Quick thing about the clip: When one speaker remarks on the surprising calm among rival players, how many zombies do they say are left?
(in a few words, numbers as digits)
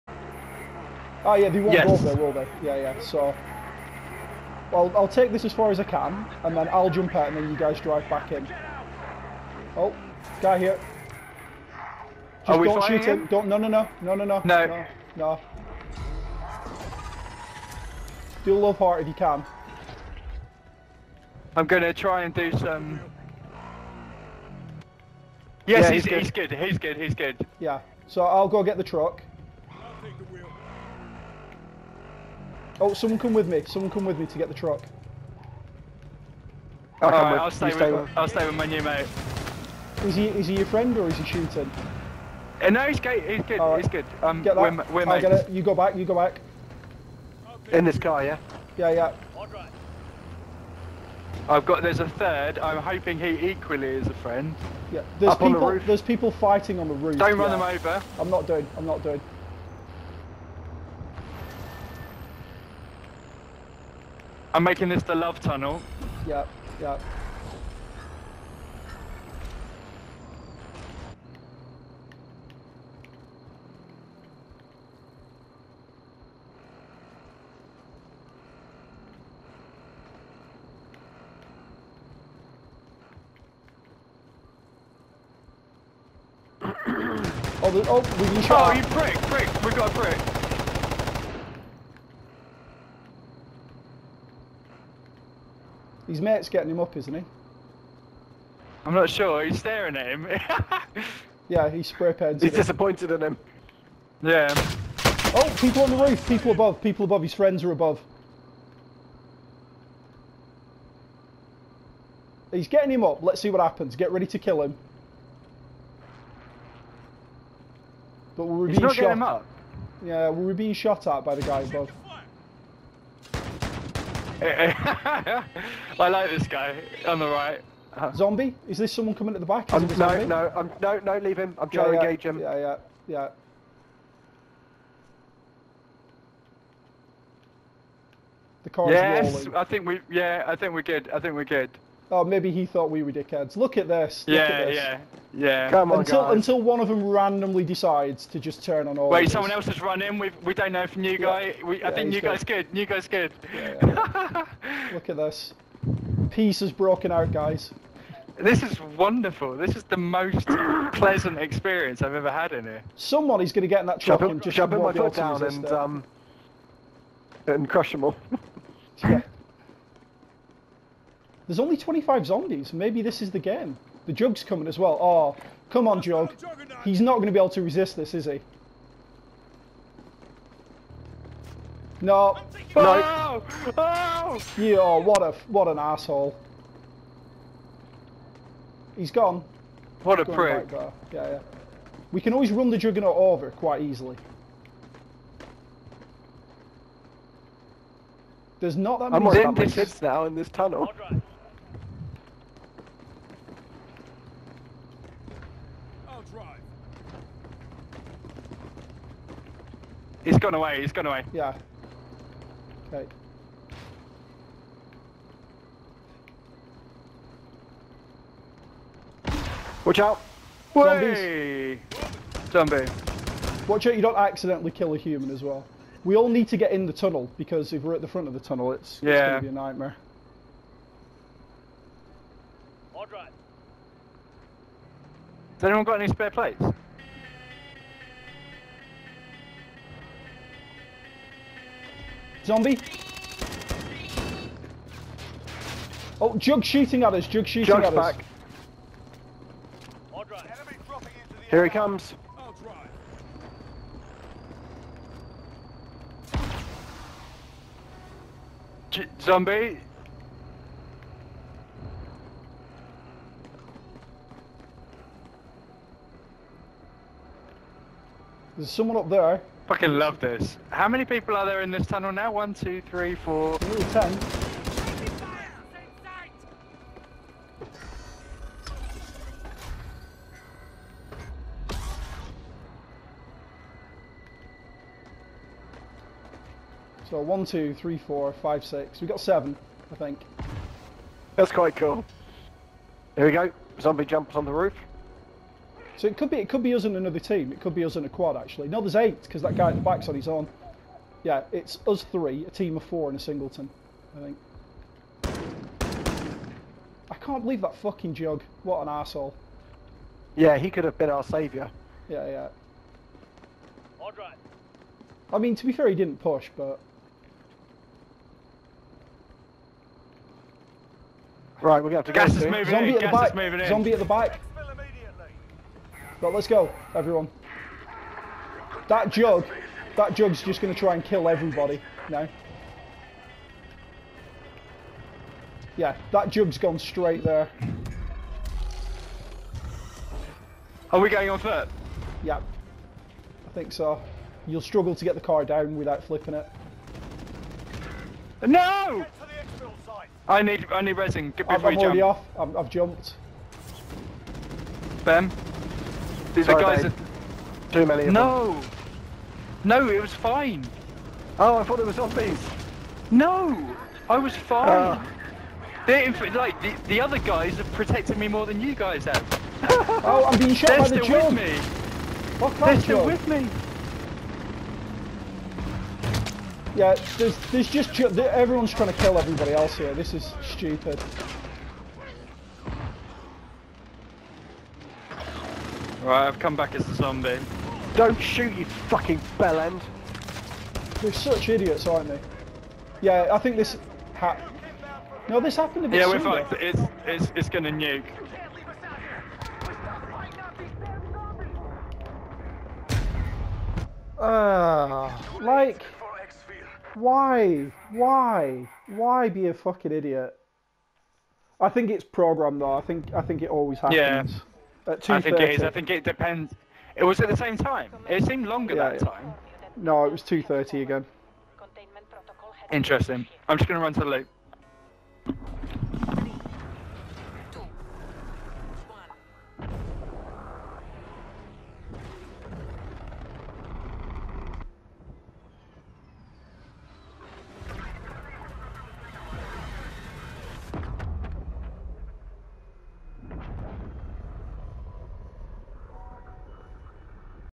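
25.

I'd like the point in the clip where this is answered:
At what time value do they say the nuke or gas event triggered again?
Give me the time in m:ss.
7:00.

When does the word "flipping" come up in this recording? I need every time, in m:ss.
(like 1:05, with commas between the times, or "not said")
5:46.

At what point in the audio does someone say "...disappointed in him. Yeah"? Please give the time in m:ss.
1:42.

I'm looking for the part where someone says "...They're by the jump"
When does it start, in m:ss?
6:10.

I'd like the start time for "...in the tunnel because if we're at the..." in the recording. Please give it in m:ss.
3:46.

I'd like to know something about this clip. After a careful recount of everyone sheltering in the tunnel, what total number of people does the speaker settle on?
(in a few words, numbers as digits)
8.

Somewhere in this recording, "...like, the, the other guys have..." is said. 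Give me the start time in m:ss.
6:06.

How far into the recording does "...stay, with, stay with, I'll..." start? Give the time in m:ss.
0:37.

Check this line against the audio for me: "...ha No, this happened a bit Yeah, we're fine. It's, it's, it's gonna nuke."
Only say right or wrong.
right.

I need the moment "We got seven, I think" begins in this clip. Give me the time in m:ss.
4:48.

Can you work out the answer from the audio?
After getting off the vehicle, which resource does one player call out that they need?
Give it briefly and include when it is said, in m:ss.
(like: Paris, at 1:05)
resin, at 5:50.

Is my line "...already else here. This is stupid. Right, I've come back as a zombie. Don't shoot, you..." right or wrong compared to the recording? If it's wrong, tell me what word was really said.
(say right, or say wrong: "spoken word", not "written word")
wrong: "everybody", not "already".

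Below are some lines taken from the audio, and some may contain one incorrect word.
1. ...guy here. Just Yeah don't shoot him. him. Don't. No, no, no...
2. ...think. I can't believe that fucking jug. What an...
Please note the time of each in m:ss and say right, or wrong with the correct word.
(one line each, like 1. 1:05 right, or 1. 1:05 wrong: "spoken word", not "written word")
1. 0:10 wrong: "Are", not "Yeah"
2. 5:04 right.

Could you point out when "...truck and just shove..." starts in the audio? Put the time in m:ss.
2:44.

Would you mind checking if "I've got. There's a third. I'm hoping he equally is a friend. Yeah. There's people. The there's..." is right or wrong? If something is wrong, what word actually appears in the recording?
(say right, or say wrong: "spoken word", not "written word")
right.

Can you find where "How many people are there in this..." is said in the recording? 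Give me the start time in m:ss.
4:30.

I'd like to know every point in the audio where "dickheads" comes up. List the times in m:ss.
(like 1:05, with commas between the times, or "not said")
2:23.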